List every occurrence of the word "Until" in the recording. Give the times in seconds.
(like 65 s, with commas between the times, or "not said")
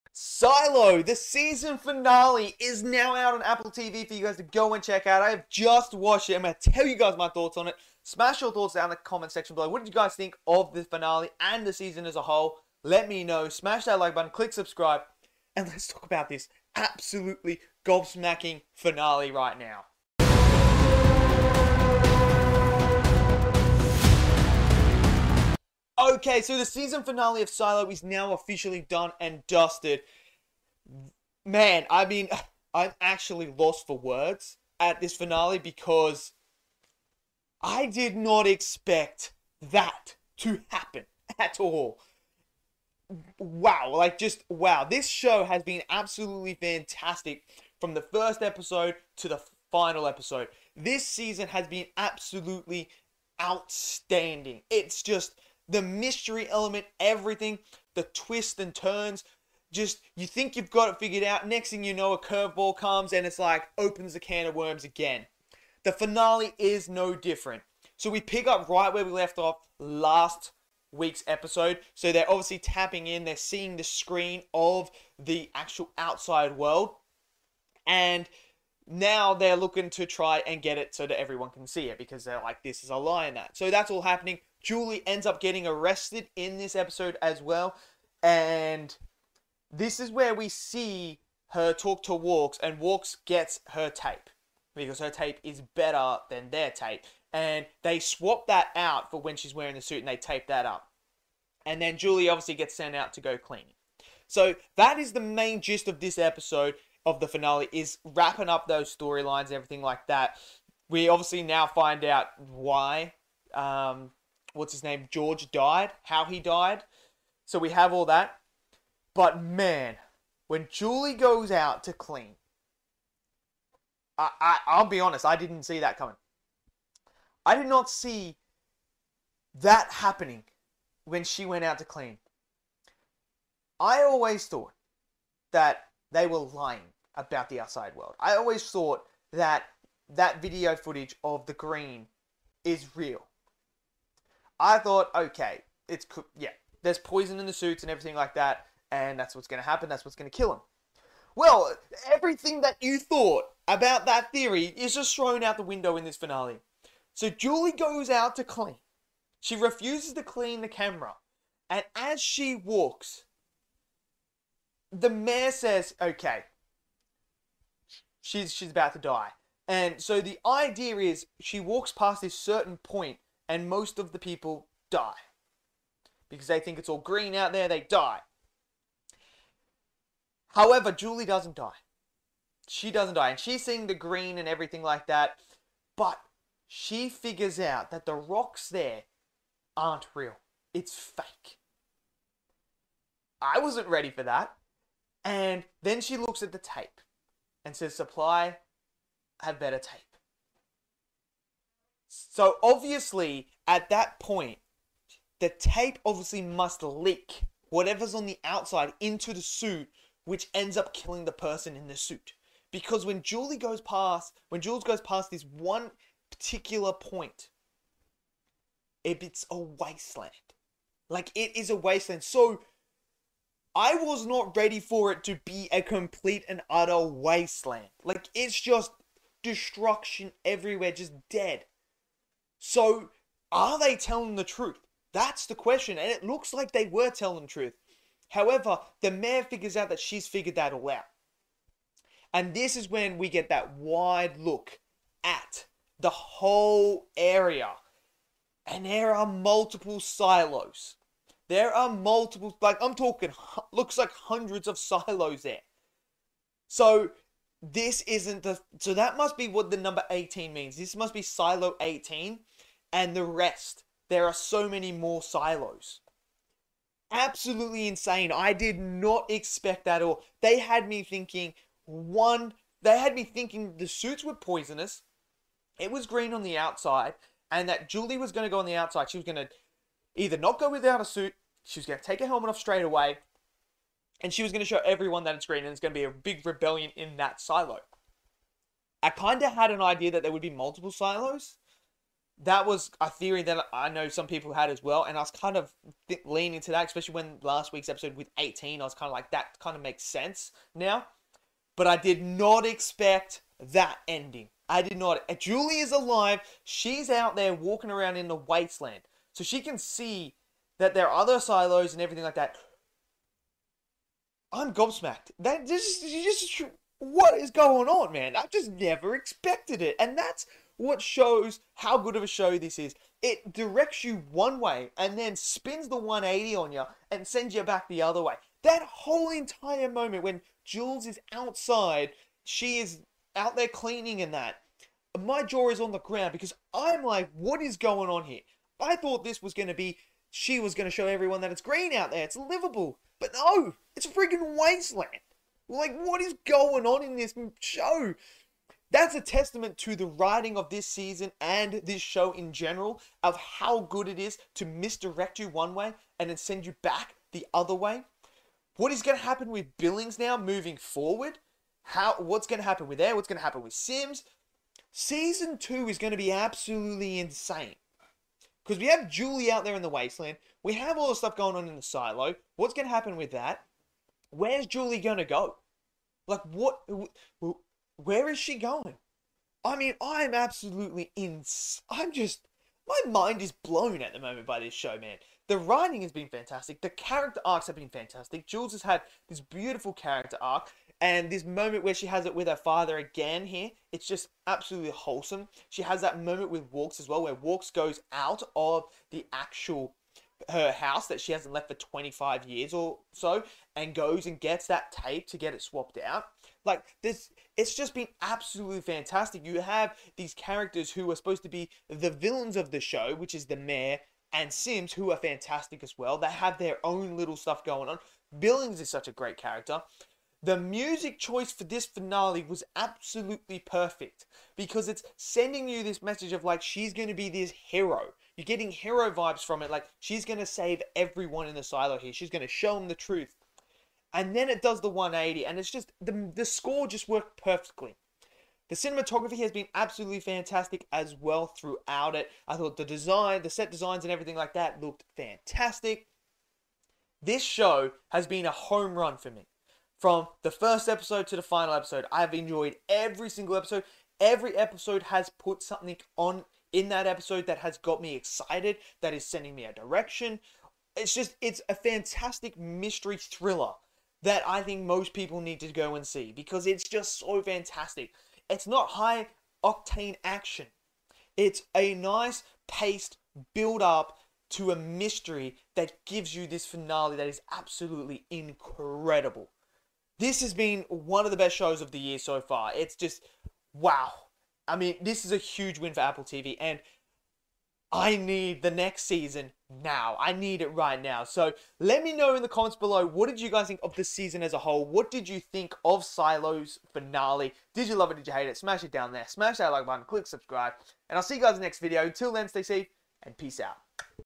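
502 s.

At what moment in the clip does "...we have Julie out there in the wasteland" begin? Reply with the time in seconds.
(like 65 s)
368 s.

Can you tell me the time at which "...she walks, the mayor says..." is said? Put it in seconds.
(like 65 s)
162 s.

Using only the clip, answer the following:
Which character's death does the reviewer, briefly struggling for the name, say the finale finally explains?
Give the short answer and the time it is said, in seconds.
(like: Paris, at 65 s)
George, at 115 s.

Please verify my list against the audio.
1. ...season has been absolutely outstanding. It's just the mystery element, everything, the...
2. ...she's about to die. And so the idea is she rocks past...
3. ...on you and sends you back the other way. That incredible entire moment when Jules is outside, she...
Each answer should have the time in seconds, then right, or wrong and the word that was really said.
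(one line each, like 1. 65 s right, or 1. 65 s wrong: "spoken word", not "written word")
1. 51 s right
2. 168 s wrong: "walks", not "rocks"
3. 326 s wrong: "whole", not "incredible".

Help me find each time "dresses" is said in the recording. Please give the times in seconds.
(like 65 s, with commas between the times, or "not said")
not said.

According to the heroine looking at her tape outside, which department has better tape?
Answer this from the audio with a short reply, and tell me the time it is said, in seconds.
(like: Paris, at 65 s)
Supply, at 197 s.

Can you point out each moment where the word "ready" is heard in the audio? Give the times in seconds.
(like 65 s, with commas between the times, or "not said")
193 s, 224 s.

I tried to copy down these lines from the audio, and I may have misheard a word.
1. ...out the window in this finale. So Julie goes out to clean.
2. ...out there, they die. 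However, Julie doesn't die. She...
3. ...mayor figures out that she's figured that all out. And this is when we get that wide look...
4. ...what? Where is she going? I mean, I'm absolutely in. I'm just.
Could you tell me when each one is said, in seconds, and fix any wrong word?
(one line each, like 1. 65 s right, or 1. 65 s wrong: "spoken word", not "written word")
1. 155 s right
2. 177 s right
3. 239 s right
4. 376 s right.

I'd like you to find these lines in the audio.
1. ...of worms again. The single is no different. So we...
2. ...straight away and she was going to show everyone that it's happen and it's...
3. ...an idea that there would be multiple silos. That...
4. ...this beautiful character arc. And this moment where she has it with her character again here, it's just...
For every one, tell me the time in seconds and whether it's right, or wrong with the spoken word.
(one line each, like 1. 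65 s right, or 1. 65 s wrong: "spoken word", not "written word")
1. 64 s wrong: "finale", not "single"
2. 282 s wrong: "green", not "happen"
3. 289 s right
4. 389 s wrong: "father", not "character".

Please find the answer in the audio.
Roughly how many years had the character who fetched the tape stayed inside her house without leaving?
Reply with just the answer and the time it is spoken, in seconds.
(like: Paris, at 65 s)
25, at 401 s.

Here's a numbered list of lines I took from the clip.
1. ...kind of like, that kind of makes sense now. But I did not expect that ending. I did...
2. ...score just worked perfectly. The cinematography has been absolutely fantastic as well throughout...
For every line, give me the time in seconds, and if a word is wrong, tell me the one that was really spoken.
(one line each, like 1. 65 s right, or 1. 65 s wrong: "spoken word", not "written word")
1. 298 s right
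2. 436 s right.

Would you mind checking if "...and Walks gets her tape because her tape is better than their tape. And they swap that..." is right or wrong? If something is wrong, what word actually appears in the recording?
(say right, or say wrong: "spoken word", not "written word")
right.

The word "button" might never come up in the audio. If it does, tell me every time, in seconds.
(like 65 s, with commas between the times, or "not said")
14 s, 499 s.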